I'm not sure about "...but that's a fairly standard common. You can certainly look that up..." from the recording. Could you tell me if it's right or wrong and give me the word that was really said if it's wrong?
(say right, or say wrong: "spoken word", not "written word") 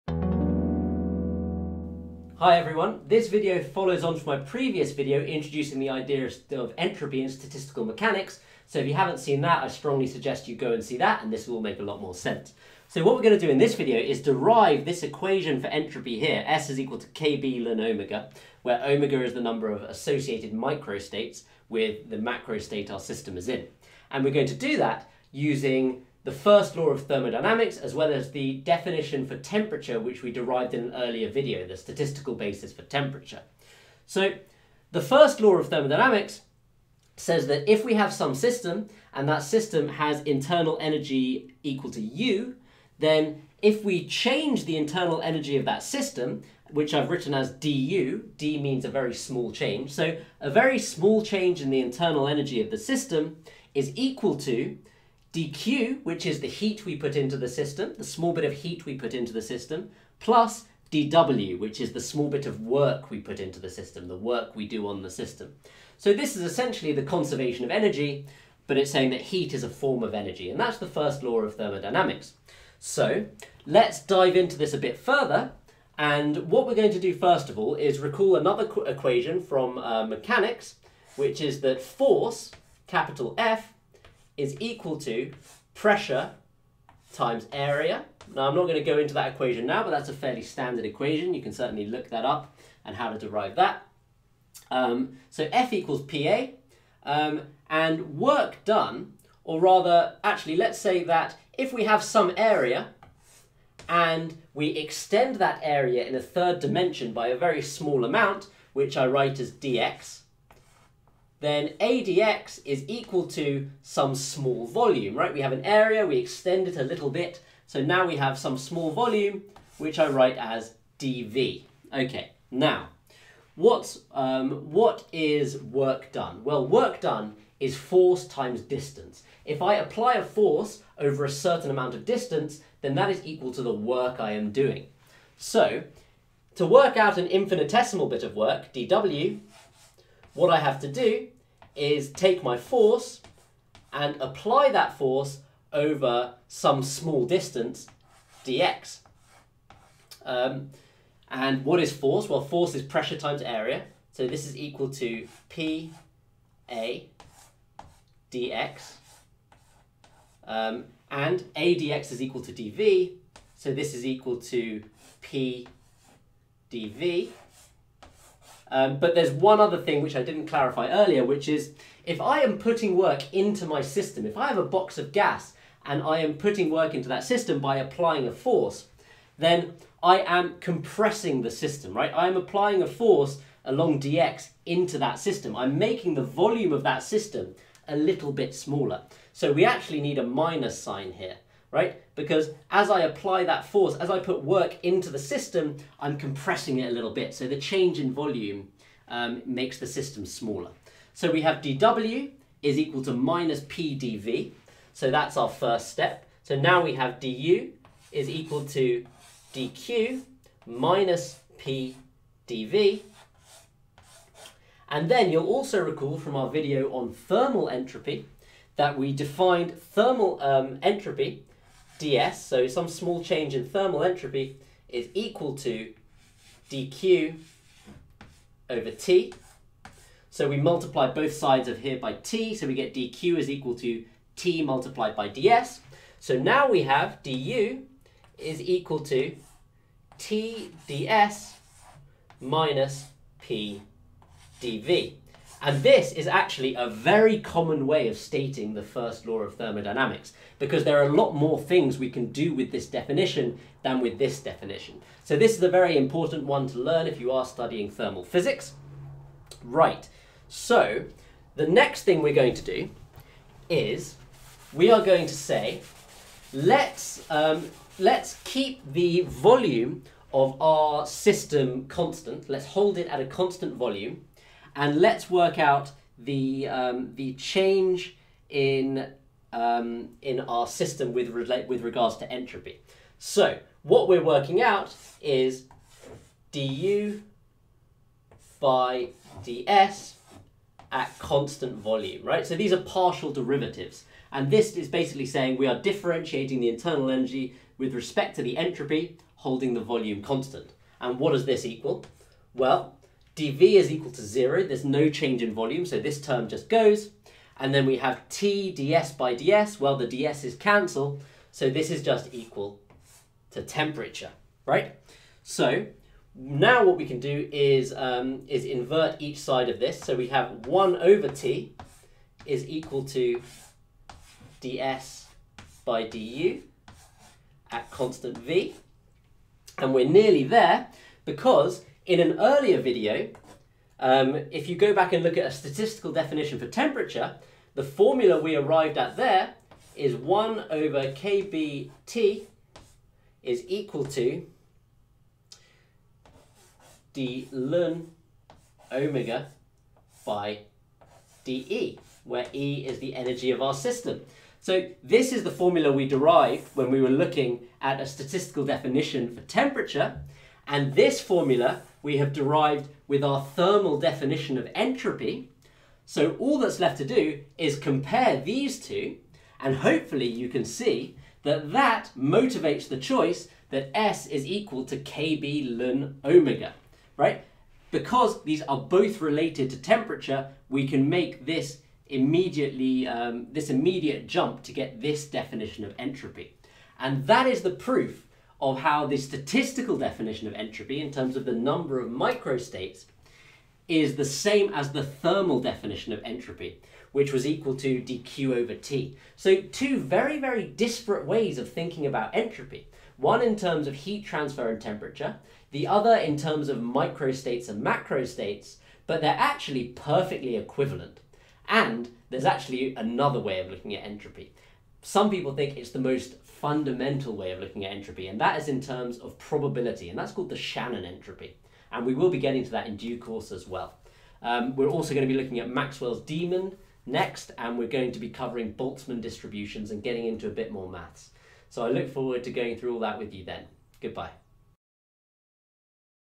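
wrong: "equation", not "common".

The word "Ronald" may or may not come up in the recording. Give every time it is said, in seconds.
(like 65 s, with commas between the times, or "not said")
not said.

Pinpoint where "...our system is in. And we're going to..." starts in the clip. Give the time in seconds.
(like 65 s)
22 s.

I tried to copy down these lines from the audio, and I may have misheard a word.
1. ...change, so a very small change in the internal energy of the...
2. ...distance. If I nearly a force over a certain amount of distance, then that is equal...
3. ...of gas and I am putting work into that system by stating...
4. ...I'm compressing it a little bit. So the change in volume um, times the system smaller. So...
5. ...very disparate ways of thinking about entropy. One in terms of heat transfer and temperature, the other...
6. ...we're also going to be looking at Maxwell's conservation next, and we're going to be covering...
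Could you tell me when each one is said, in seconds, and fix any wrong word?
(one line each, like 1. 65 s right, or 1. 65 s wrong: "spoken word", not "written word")
1. 49 s right
2. 128 s wrong: "apply", not "nearly"
3. 174 s wrong: "applying", not "stating"
4. 195 s wrong: "makes", not "times"
5. 400 s right
6. 424 s wrong: "demon", not "conservation".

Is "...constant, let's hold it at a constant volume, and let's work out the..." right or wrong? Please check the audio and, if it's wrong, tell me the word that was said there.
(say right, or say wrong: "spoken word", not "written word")
right.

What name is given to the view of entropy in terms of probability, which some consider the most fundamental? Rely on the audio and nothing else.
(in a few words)
Shannon entropy.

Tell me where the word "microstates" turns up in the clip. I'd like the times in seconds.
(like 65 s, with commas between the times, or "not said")
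20 s, 392 s, 406 s.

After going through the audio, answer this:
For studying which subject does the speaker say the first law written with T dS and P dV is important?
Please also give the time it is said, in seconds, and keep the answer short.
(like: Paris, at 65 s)
Thermal physics, at 257 s.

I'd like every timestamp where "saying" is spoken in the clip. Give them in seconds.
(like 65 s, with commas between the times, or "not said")
68 s, 295 s.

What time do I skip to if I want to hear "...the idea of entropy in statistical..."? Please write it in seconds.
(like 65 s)
5 s.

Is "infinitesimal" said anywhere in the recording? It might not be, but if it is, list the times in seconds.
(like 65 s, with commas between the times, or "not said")
137 s.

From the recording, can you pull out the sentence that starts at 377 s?
Because these are both related to temperature, we can make this immediately, um, this immediate jump to get this definition of entropy.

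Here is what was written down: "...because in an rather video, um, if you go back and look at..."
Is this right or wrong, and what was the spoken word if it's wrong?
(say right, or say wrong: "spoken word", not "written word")
wrong: "earlier", not "rather".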